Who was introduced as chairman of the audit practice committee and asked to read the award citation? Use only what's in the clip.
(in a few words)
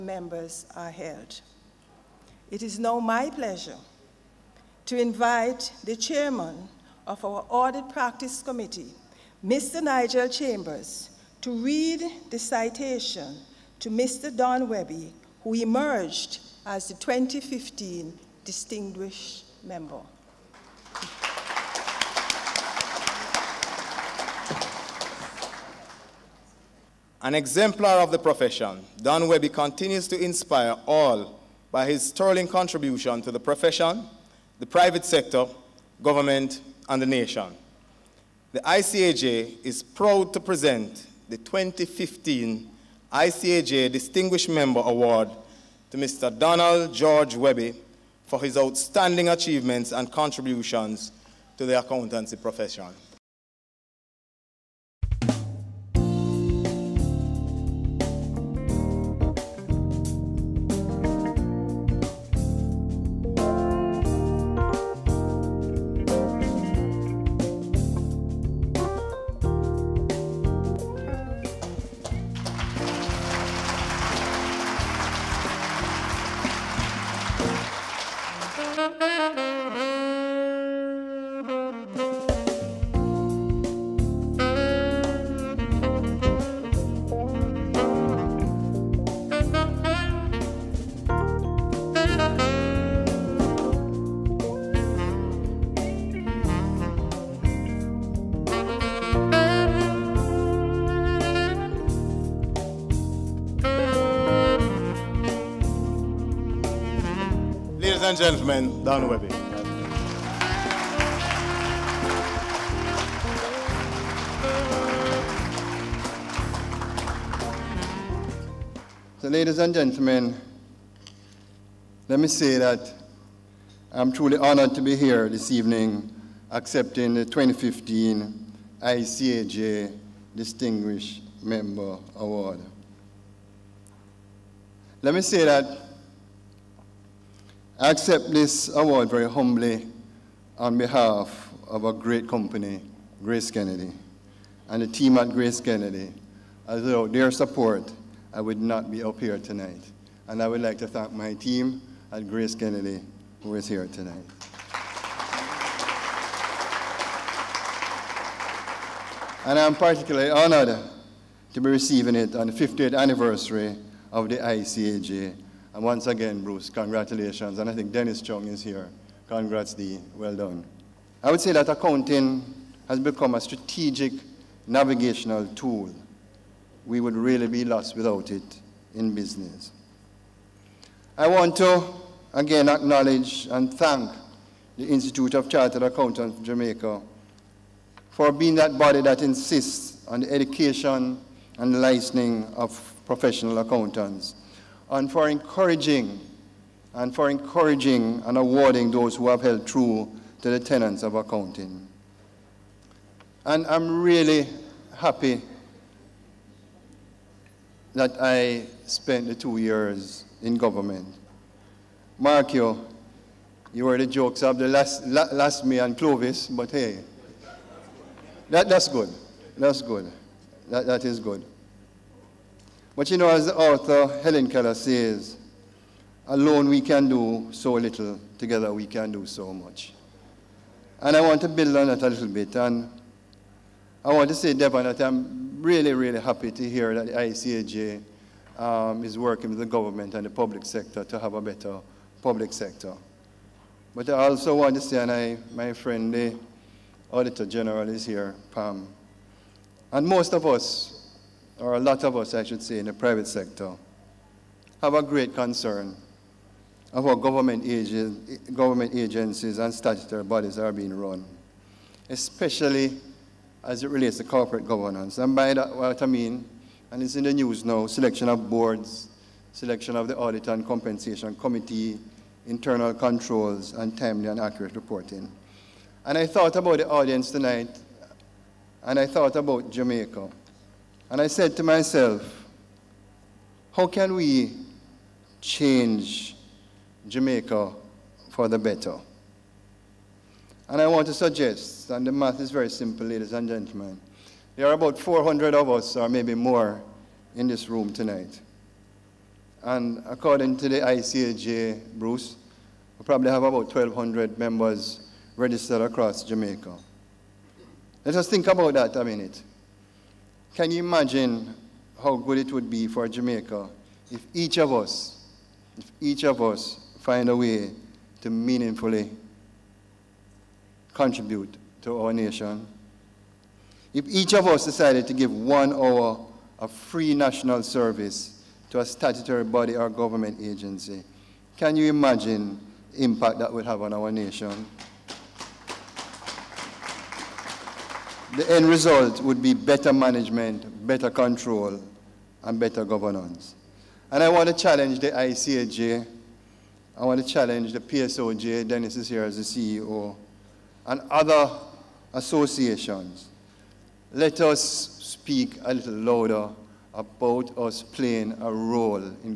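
Nigel Chambers.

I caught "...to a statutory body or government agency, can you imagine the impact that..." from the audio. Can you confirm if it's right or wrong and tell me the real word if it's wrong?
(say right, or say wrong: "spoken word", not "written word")
right.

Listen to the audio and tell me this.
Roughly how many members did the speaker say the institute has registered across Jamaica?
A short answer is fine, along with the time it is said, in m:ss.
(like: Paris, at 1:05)
1,200, at 5:03.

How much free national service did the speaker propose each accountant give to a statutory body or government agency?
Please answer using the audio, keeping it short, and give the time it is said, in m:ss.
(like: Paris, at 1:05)
one hour, at 5:25.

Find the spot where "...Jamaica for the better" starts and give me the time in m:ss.
4:47.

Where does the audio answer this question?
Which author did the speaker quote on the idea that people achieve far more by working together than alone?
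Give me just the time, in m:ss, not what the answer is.
3:44.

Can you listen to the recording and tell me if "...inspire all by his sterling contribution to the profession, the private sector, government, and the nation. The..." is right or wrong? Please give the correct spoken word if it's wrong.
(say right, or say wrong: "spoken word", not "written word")
right.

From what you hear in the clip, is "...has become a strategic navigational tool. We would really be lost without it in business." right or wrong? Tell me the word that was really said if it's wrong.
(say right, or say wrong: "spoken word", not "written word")
right.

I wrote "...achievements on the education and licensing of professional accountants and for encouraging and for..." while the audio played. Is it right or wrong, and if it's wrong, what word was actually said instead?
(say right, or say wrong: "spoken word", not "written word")
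wrong: "insists", not "achievements".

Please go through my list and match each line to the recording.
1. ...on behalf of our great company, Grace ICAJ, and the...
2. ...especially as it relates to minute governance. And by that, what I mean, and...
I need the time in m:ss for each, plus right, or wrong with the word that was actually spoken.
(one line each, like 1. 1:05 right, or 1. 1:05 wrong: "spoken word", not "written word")
1. 2:20 wrong: "Kennedy", not "ICAJ"
2. 4:22 wrong: "corporate", not "minute".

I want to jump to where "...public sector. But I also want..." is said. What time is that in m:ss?
4:02.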